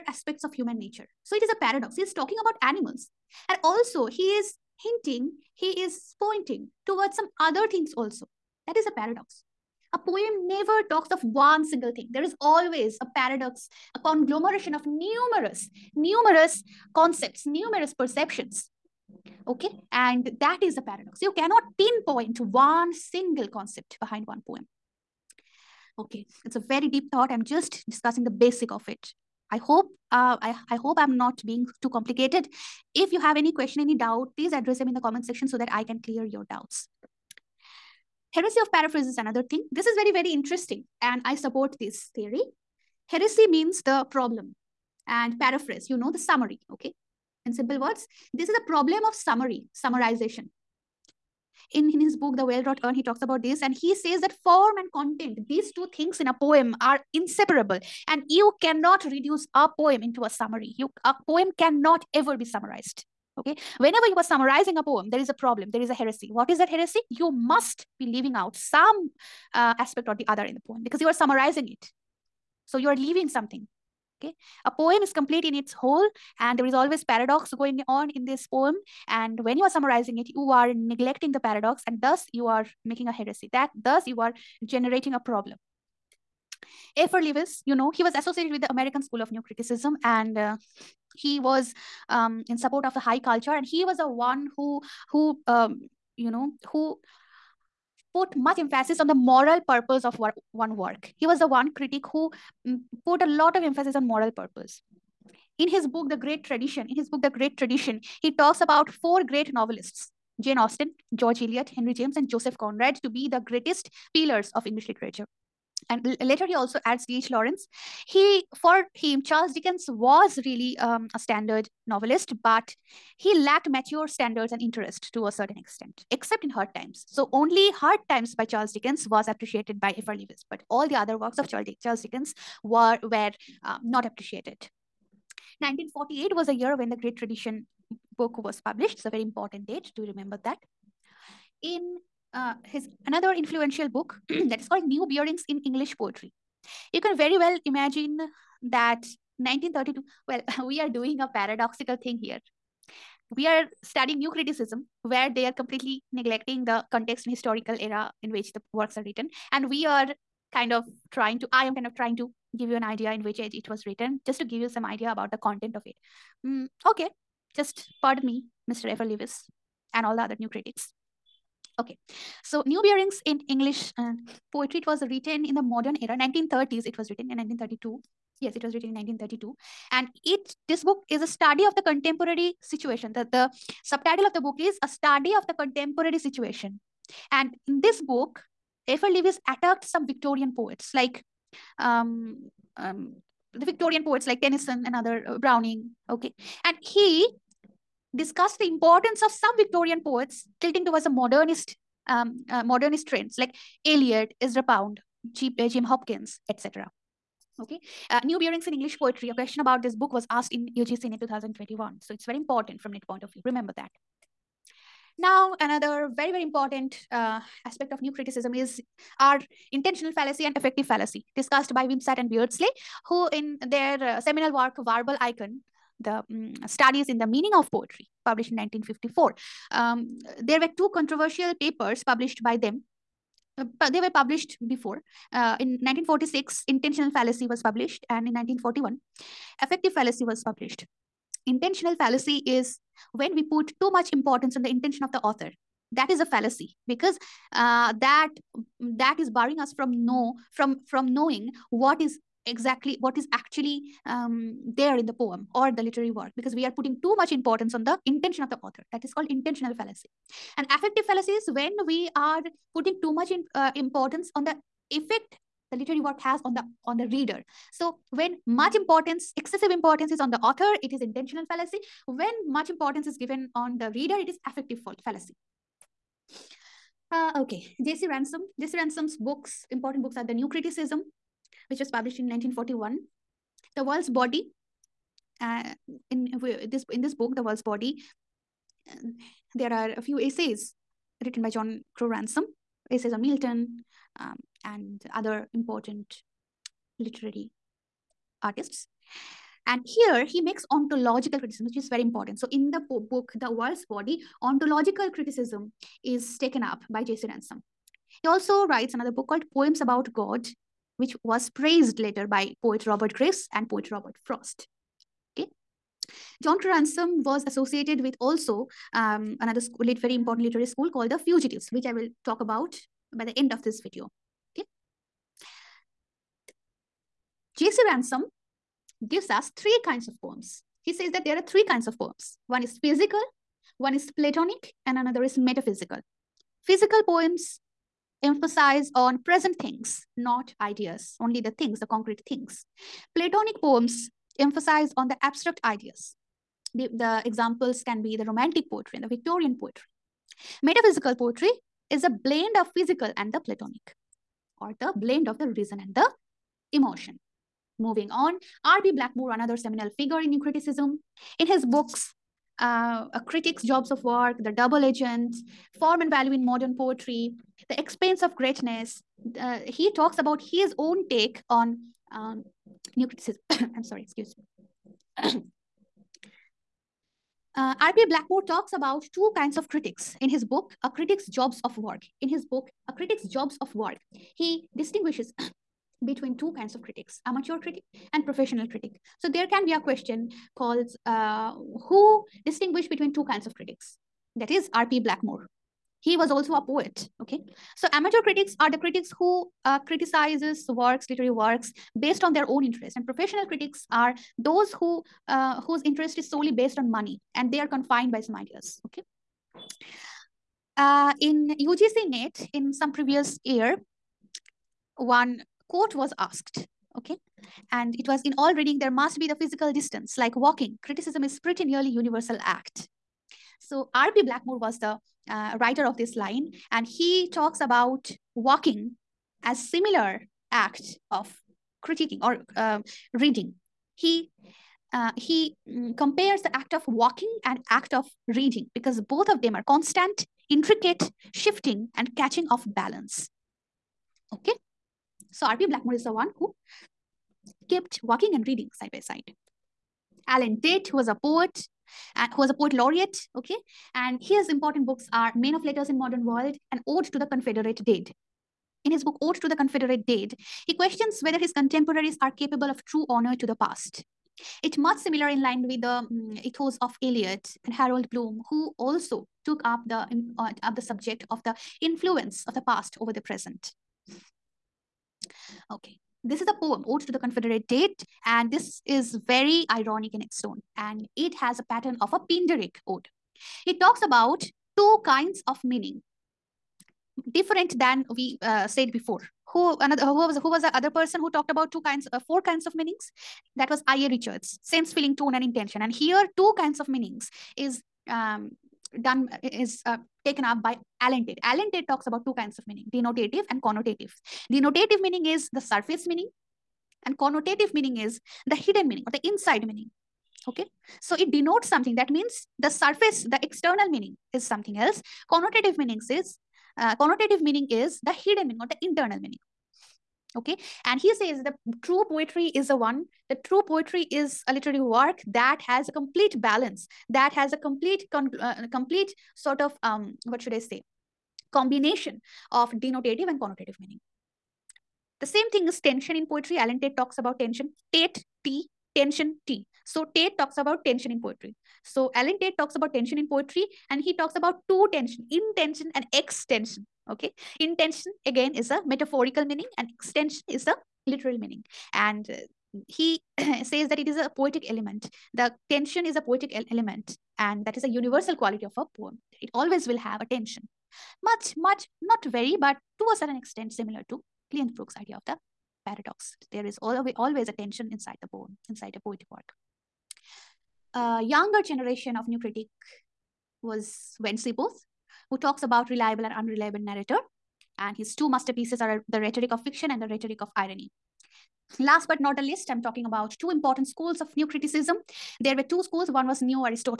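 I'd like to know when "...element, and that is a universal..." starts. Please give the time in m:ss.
9:16.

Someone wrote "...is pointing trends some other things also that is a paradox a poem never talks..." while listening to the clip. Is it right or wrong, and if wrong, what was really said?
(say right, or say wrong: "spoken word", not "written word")
wrong: "towards", not "trends".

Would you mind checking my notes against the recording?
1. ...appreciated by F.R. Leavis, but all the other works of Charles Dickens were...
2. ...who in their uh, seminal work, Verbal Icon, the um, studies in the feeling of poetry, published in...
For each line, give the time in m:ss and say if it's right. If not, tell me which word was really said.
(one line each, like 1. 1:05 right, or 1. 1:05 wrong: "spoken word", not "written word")
1. 2:09 right
2. 3:43 wrong: "meaning", not "feeling".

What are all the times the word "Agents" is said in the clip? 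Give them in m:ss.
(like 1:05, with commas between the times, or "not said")
6:04.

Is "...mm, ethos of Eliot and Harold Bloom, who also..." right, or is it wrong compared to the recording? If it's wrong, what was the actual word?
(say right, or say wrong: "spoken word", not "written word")
right.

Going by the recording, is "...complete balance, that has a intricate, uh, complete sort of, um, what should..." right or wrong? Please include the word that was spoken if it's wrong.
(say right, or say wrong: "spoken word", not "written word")
wrong: "complete", not "intricate".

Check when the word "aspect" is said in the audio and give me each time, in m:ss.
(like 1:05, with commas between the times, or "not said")
0:00, 1:09, 3:37.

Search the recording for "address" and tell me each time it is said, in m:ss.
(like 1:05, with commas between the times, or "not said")
0:34.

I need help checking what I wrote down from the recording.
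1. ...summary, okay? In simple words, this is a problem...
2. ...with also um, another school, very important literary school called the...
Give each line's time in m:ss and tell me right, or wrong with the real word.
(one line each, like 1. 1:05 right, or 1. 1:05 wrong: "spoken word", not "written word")
1. 0:46 right
2. 5:18 right.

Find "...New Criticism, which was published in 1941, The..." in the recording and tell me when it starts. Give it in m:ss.
4:40.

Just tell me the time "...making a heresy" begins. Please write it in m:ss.
1:22.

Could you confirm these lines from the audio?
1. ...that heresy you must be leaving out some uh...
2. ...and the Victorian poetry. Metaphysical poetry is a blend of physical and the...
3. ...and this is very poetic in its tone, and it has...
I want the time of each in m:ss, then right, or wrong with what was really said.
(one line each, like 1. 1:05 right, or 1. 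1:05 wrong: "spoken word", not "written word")
1. 1:06 right
2. 5:48 right
3. 7:58 wrong: "ironic", not "poetic".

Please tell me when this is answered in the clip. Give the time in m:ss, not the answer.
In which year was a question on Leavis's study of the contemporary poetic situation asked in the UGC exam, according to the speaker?
3:31.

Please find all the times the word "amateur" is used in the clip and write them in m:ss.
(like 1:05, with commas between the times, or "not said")
6:27, 6:37.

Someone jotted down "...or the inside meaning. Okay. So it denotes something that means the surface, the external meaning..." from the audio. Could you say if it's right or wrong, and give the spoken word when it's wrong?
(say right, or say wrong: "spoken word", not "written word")
right.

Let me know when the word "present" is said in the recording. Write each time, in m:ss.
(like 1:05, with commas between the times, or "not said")
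5:39, 7:53.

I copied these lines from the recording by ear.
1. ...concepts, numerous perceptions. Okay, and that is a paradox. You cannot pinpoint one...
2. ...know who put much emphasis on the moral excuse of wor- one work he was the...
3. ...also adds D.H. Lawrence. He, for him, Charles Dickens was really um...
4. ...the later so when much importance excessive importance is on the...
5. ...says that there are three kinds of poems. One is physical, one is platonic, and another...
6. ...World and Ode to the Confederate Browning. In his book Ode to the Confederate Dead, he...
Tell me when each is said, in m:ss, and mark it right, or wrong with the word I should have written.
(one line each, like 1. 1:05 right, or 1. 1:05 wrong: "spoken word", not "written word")
1. 0:16 right
2. 1:36 wrong: "purpose", not "excuse"
3. 1:56 right
4. 4:26 wrong: "reader", not "later"
5. 5:30 right
6. 7:36 wrong: "Dead", not "Browning".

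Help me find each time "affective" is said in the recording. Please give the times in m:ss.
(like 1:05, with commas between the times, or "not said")
3:40, 3:59, 4:20, 4:34.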